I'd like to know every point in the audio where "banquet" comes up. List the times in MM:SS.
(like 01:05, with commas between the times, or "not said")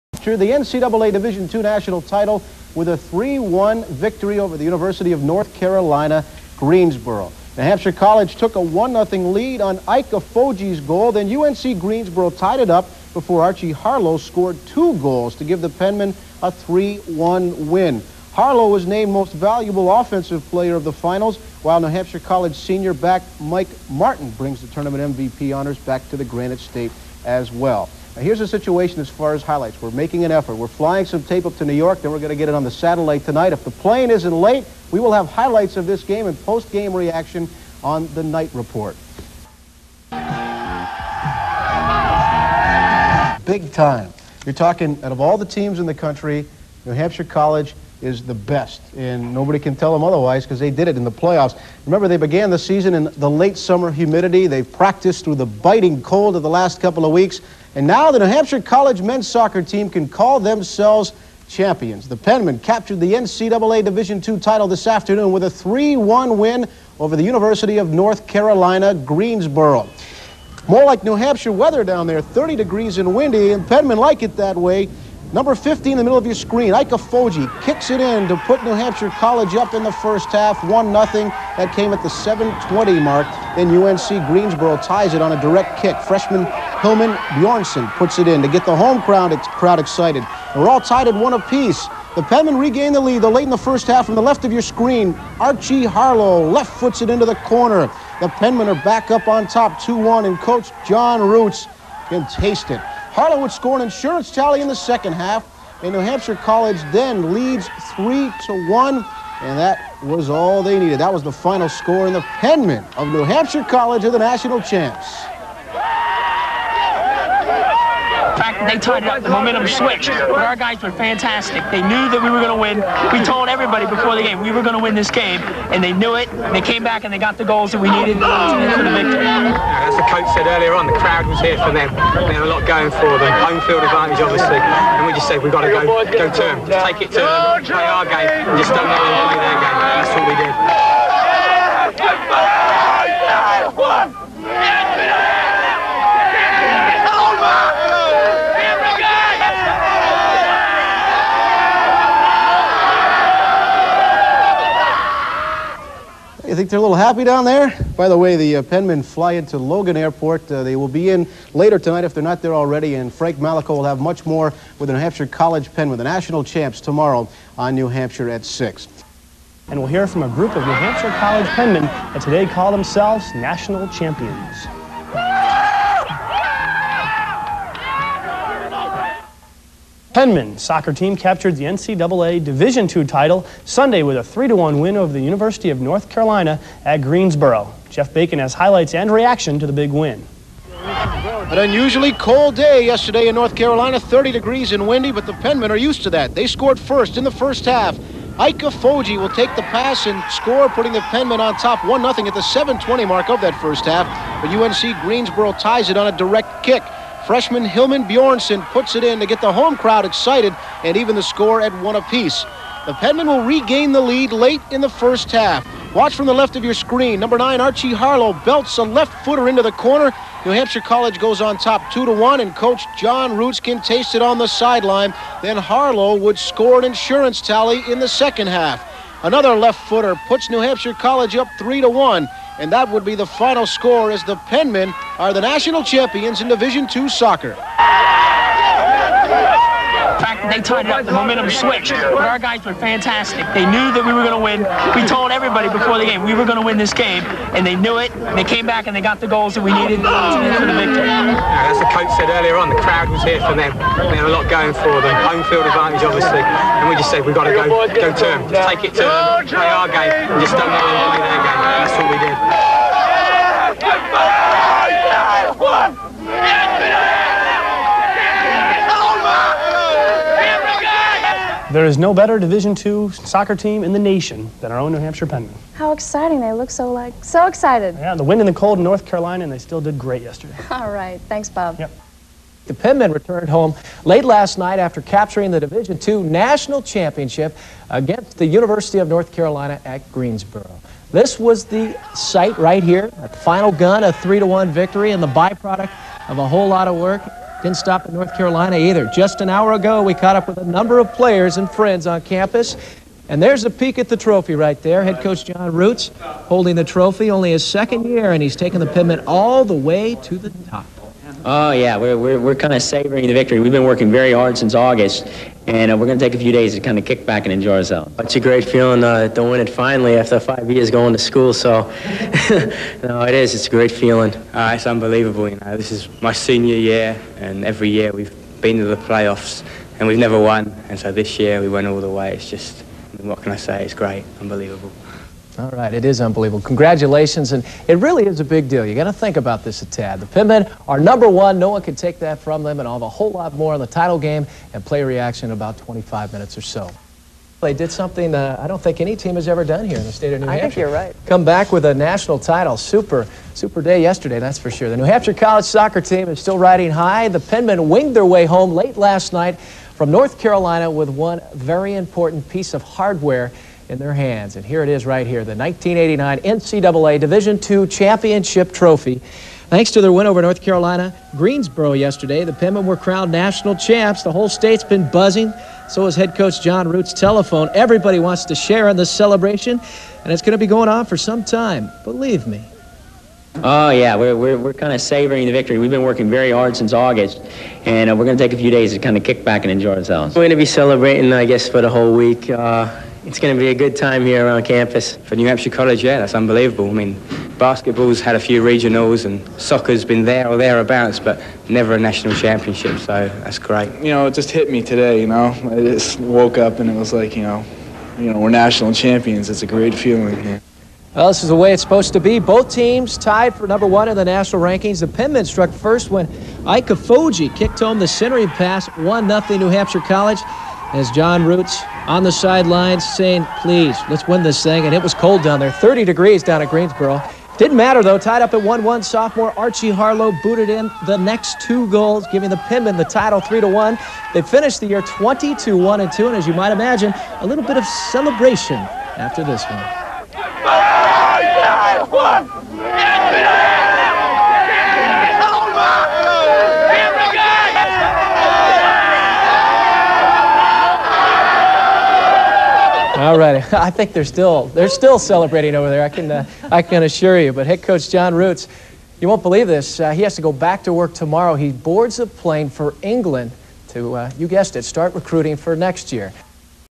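not said.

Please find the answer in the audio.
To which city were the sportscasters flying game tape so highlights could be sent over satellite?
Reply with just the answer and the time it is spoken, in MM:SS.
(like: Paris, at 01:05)
New York, at 00:31.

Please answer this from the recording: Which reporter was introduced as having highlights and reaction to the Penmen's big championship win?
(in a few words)
Jeff Bacon.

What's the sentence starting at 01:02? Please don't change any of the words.
The Penmen captured the NCAA Division II title this afternoon with a 3-1 win over the University of North Carolina, Greensboro.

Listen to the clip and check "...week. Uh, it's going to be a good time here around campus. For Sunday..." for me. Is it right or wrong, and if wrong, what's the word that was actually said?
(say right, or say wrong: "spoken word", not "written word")
wrong: "New", not "Sunday".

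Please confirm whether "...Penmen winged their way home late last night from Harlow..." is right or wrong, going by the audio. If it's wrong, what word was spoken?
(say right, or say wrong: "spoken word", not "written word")
wrong: "North", not "Harlow".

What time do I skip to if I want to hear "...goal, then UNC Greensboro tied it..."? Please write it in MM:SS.
00:10.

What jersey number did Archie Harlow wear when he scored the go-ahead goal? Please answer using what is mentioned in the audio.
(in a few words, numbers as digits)
9.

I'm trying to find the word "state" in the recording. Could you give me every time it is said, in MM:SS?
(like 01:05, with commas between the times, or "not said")
00:26, 05:50, 06:14.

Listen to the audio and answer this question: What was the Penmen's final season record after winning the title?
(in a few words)
22-1-2.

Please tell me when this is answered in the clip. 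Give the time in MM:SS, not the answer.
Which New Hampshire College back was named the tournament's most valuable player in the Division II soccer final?
00:23.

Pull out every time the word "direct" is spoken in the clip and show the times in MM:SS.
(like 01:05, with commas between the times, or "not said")
01:25, 03:26.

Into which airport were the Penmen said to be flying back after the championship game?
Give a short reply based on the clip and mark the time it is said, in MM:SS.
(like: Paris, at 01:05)
Logan Airport, at 02:39.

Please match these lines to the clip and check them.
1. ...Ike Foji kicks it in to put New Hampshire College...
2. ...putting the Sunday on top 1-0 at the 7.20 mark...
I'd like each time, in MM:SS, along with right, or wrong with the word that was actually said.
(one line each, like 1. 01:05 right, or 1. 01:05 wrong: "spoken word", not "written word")
1. 01:16 right
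2. 03:20 wrong: "Penmen", not "Sunday".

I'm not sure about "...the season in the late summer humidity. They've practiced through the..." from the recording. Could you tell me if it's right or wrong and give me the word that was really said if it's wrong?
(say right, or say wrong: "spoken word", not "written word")
right.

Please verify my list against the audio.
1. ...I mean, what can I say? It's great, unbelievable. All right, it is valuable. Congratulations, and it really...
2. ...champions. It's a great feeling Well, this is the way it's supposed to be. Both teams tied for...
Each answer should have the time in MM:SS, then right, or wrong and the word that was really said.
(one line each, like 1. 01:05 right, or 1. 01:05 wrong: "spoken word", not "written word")
1. 05:33 wrong: "unbelievable", not "valuable"
2. 06:48 right.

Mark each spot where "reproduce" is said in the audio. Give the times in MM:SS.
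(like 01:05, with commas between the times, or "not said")
not said.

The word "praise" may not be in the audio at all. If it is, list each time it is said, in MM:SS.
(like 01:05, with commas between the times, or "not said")
not said.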